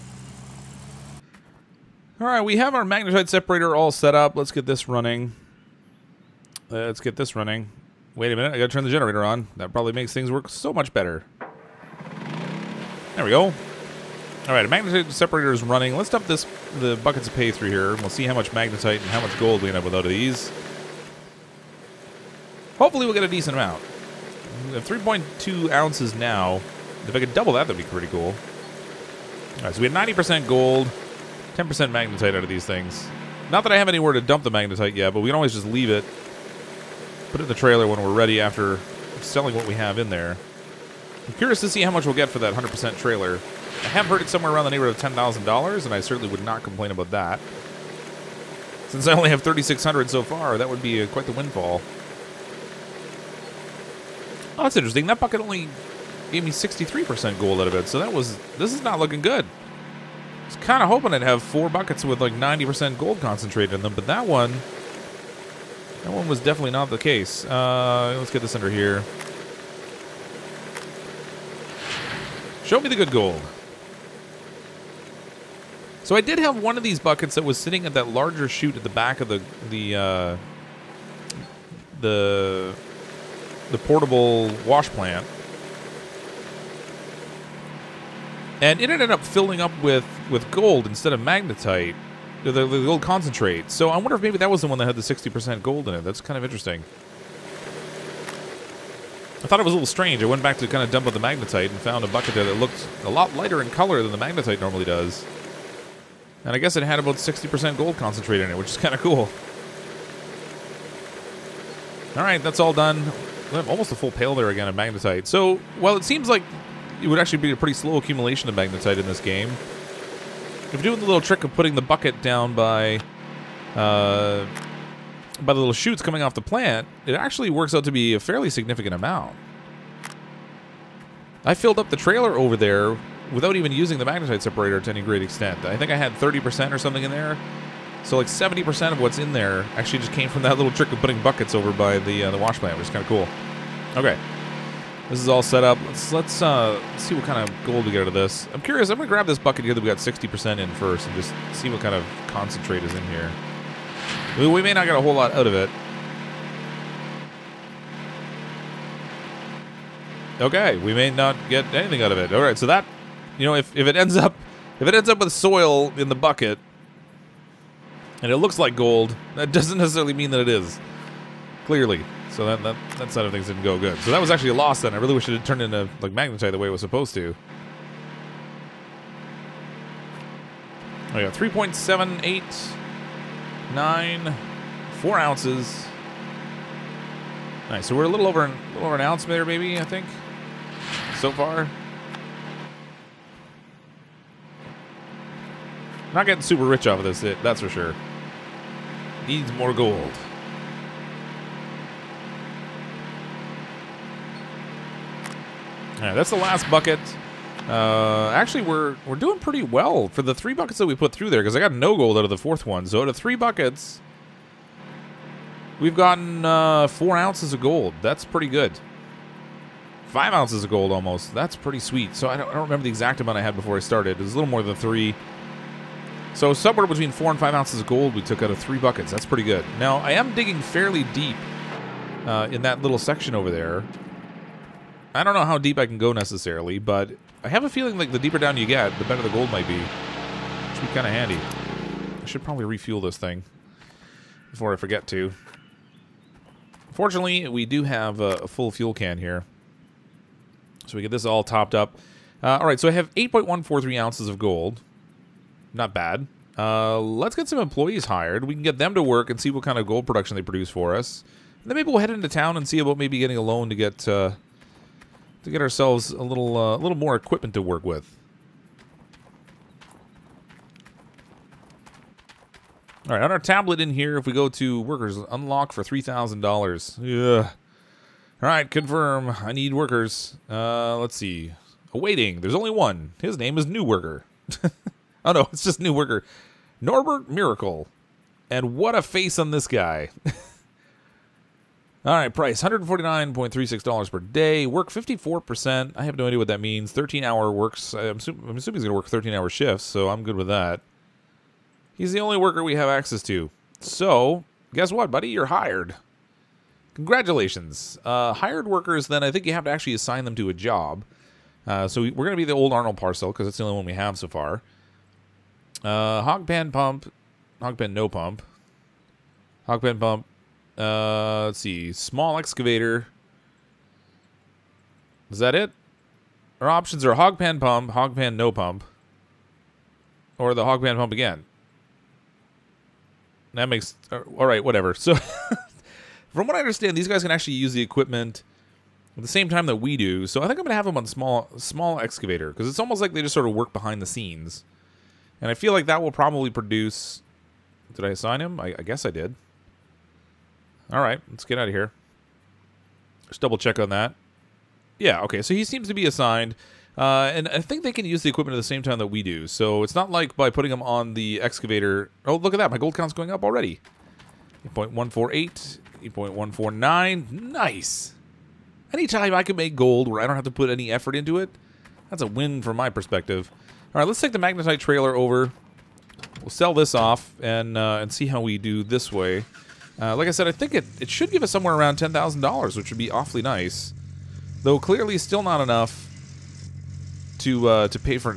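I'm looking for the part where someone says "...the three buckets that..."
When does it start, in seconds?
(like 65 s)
210 s.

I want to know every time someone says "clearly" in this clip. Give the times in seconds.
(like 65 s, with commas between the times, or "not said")
171 s, 384 s.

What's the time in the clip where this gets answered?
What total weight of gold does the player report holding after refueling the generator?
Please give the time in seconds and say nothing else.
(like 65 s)
253 s.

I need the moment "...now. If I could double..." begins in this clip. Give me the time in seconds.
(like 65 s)
26 s.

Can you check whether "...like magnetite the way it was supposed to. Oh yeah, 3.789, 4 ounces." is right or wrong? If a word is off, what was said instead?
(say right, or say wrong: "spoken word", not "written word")
right.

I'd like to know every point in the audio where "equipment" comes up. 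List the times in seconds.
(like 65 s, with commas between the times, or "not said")
267 s, 337 s, 358 s.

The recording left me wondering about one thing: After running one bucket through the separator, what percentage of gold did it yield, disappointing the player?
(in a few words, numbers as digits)
63%.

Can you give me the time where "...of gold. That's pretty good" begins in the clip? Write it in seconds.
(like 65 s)
217 s.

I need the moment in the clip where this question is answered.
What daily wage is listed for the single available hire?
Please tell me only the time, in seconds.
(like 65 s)
292 s.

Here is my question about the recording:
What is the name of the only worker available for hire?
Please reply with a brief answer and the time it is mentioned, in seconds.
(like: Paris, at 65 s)
Norbert Miracle, at 286 s.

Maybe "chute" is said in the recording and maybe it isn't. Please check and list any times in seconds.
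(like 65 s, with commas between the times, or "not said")
78 s, 125 s.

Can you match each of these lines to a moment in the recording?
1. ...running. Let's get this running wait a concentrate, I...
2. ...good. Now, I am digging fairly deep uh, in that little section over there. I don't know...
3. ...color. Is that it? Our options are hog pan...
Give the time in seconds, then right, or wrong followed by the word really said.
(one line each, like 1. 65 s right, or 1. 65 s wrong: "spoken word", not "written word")
1. 4 s wrong: "minute", not "concentrate"
2. 229 s right
3. 322 s wrong: "excavator", not "color".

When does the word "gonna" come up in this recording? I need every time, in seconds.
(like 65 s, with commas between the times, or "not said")
148 s, 340 s.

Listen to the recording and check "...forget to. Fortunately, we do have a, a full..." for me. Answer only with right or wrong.
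right.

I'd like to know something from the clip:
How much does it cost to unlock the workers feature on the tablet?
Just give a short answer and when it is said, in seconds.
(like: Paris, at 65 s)
$3,000, at 275 s.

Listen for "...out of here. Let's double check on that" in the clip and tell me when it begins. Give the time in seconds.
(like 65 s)
351 s.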